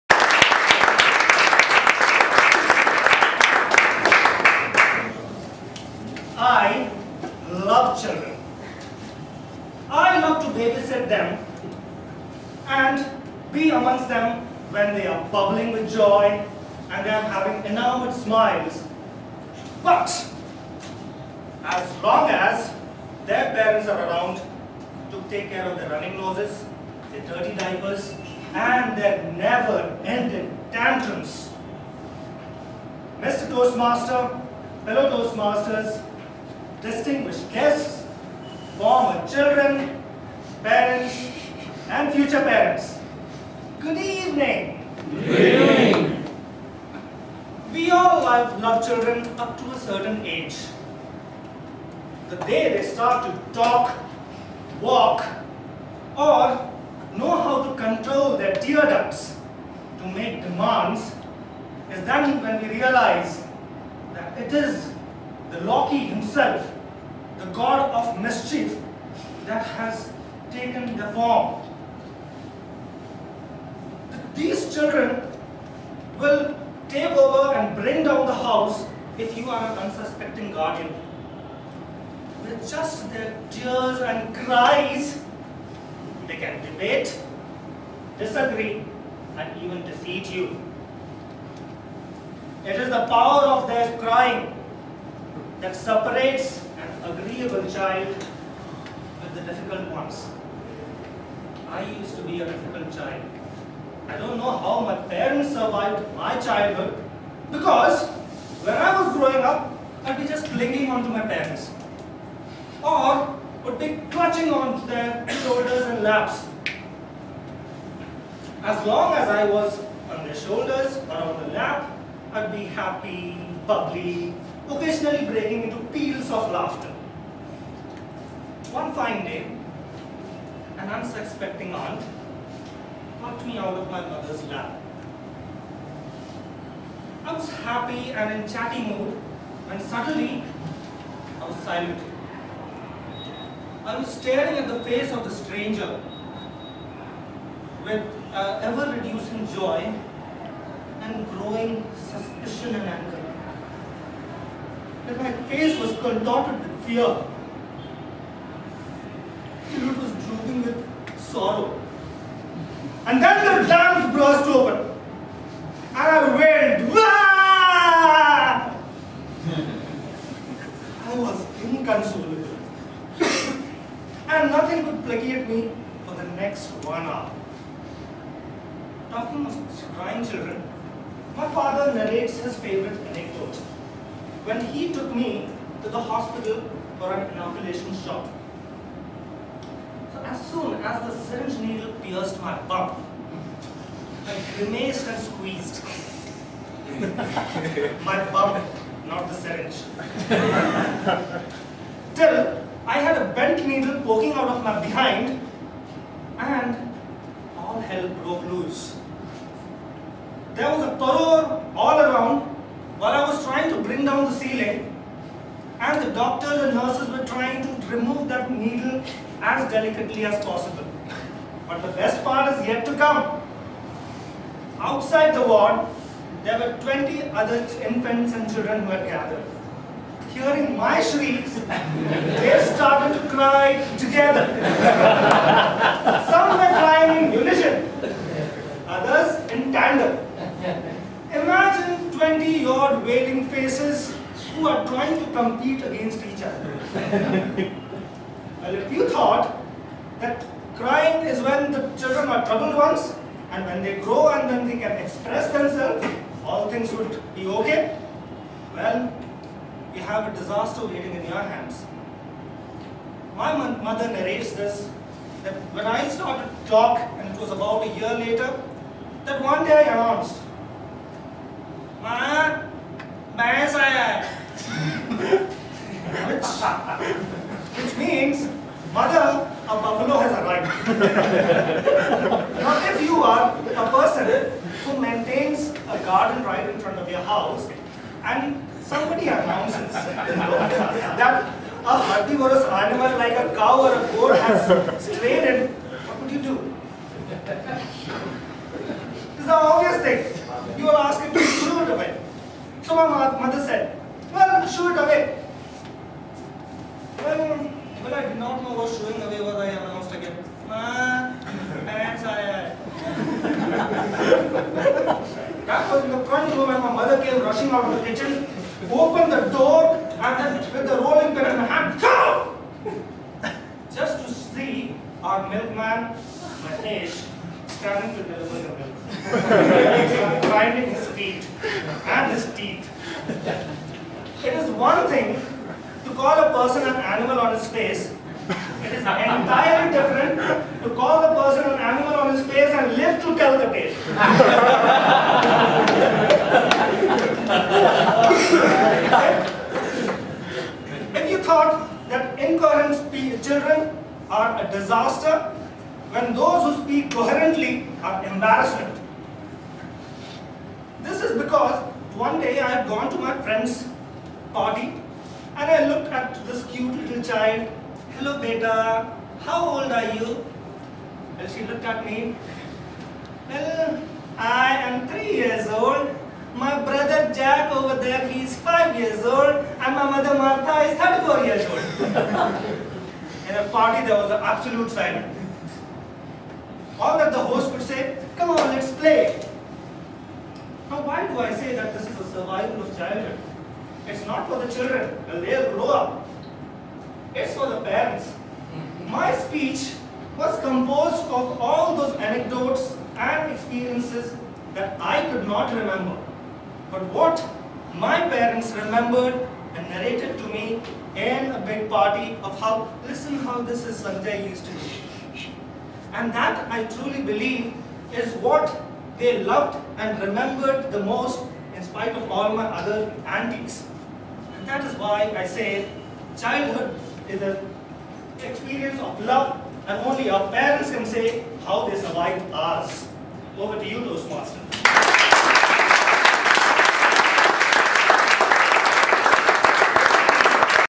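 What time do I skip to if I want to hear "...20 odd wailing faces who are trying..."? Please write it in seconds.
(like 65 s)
242 s.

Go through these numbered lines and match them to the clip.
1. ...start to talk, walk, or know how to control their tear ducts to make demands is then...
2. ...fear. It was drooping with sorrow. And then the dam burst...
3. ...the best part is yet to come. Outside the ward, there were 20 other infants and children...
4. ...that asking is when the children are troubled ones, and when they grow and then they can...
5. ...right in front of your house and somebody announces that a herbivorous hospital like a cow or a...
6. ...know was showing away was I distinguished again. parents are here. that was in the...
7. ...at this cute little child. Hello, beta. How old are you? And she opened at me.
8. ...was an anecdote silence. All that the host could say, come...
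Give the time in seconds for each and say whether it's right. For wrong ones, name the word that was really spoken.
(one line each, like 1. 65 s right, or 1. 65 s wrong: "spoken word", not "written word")
1. 52 s right
2. 156 s right
3. 221 s right
4. 250 s wrong: "crying", not "asking"
5. 286 s wrong: "animal", not "hospital"
6. 308 s wrong: "announced", not "distinguished"
7. 366 s wrong: "looked", not "opened"
8. 384 s wrong: "absolute", not "anecdote".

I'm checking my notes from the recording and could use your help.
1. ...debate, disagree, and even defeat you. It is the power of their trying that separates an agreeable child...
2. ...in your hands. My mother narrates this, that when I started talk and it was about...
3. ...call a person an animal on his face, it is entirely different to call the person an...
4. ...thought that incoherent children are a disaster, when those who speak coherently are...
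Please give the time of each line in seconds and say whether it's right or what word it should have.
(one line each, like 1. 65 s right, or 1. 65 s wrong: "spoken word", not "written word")
1. 86 s wrong: "crying", not "trying"
2. 261 s right
3. 336 s right
4. 351 s right.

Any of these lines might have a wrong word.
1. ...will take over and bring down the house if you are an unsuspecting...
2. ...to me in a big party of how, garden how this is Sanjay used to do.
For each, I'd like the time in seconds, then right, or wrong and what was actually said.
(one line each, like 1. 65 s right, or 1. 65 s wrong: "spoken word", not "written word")
1. 76 s right
2. 410 s wrong: "listen", not "garden".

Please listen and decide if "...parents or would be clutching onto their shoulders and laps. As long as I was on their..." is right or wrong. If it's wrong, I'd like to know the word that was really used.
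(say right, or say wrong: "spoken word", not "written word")
right.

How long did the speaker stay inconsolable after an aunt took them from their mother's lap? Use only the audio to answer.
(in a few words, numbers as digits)
one hour.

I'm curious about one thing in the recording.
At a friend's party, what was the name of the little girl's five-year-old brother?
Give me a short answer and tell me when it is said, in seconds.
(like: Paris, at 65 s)
Jack, at 377 s.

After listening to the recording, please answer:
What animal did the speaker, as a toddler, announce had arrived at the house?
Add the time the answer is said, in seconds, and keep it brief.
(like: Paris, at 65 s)
buffalo, at 279 s.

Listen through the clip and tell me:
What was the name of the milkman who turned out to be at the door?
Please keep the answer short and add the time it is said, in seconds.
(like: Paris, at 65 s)
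Matesh, at 326 s.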